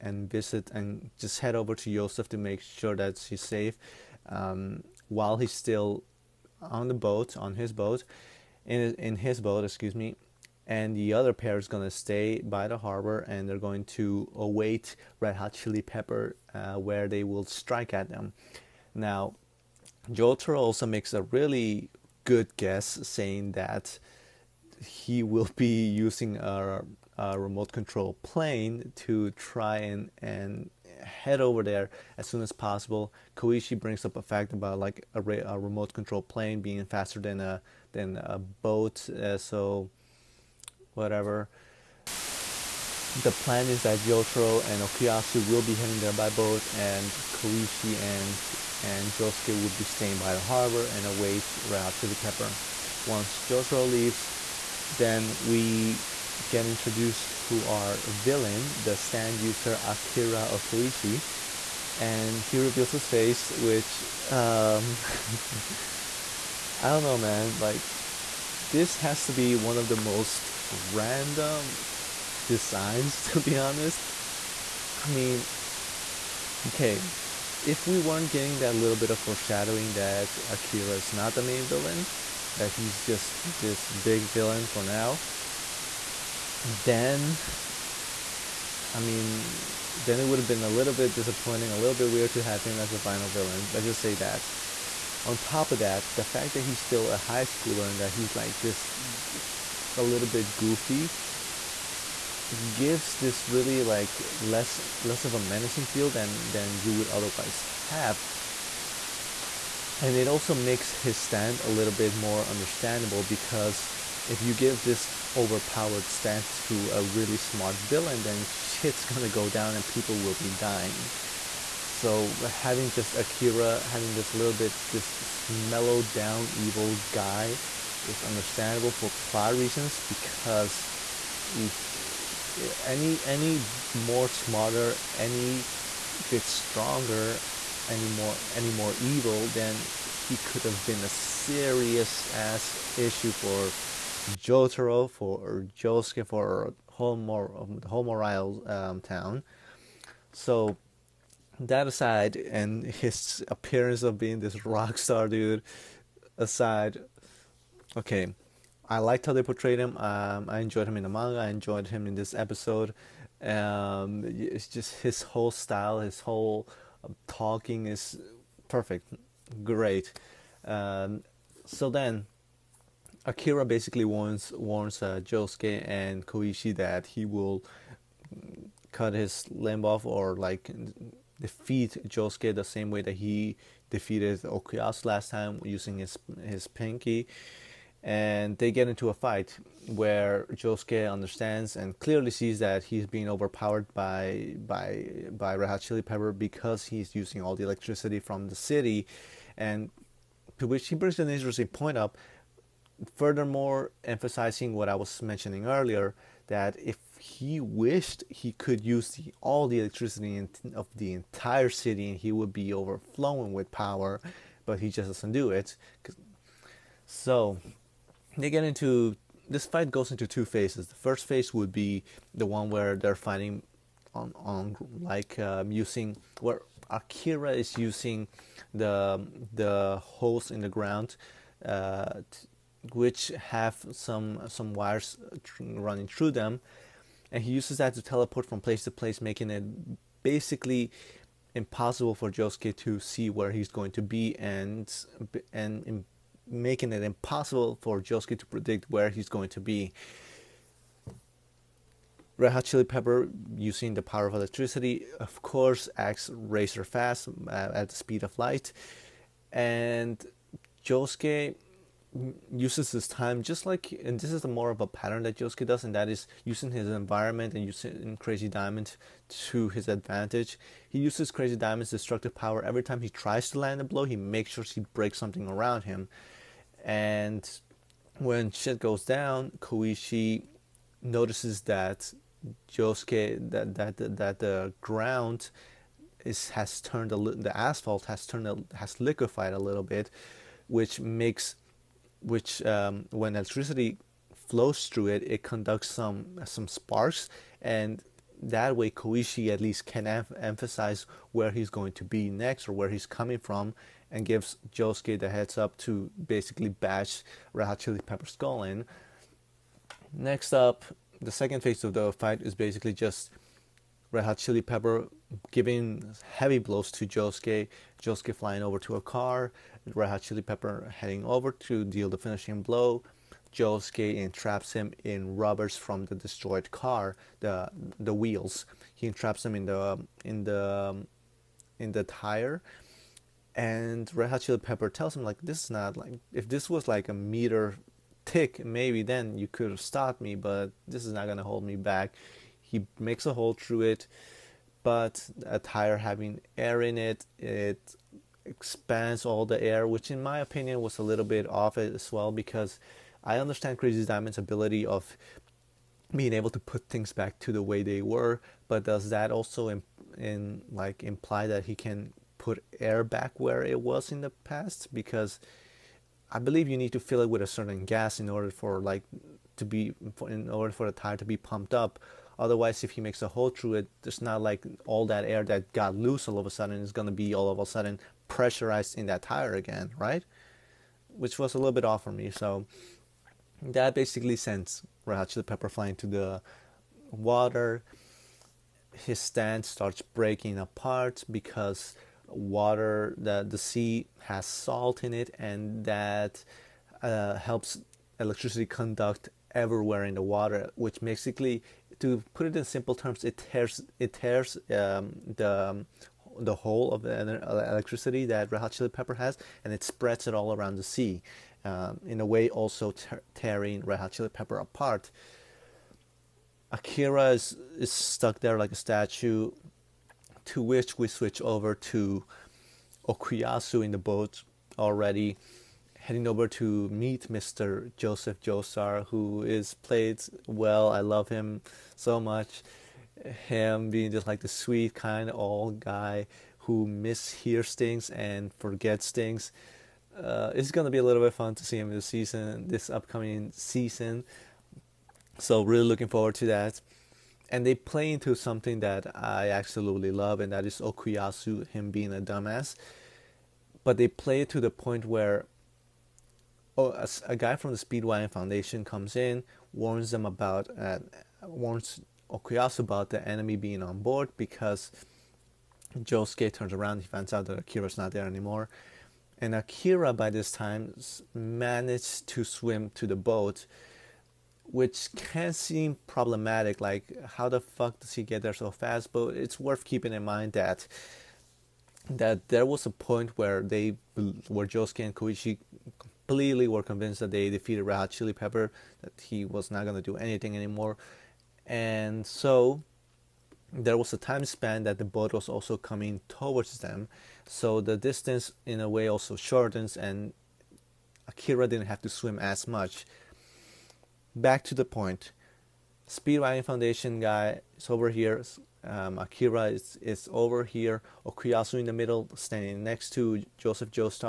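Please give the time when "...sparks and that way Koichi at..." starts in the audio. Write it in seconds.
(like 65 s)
296 s.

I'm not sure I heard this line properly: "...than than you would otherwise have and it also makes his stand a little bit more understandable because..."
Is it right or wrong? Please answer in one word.
right.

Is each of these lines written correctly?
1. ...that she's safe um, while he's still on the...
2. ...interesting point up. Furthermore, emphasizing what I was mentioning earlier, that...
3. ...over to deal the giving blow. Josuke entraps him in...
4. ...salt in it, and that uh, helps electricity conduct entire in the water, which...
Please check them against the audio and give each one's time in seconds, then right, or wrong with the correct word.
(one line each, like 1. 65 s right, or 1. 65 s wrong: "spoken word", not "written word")
1. 2 s right
2. 201 s right
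3. 321 s wrong: "finishing", not "giving"
4. 394 s wrong: "everywhere", not "entire".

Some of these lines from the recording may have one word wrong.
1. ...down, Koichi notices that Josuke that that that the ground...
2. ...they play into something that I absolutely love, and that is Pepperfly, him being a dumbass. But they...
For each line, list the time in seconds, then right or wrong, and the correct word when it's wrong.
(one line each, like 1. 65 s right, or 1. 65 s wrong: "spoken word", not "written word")
1. 279 s right
2. 447 s wrong: "Okuyasu", not "Pepperfly".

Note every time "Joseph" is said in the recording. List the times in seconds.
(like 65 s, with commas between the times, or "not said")
1 s, 427 s, 513 s.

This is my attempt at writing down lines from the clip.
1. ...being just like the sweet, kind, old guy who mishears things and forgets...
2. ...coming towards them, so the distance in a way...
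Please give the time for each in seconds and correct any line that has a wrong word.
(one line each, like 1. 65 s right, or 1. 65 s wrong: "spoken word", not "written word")
1. 433 s right
2. 495 s right.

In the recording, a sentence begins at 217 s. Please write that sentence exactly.
So they get into this fight goes into two phases.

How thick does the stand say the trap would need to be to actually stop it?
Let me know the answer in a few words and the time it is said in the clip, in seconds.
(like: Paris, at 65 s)
A meter, at 337 s.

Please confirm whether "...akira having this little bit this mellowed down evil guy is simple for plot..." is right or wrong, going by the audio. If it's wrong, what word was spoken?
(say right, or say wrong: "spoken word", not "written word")
wrong: "understandable", not "simple".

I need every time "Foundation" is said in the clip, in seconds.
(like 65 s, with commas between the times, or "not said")
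458 s, 506 s.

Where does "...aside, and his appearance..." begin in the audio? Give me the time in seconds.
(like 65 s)
151 s.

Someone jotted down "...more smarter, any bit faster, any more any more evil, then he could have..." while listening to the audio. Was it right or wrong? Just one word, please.
wrong.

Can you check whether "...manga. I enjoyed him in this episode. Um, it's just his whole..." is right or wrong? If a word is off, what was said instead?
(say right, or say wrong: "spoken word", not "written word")
right.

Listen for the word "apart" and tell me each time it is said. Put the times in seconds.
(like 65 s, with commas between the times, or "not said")
390 s, 414 s.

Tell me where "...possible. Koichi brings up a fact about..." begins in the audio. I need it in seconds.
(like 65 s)
32 s.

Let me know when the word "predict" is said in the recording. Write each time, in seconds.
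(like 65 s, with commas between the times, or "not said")
248 s.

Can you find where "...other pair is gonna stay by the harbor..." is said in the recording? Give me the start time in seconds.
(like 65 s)
11 s.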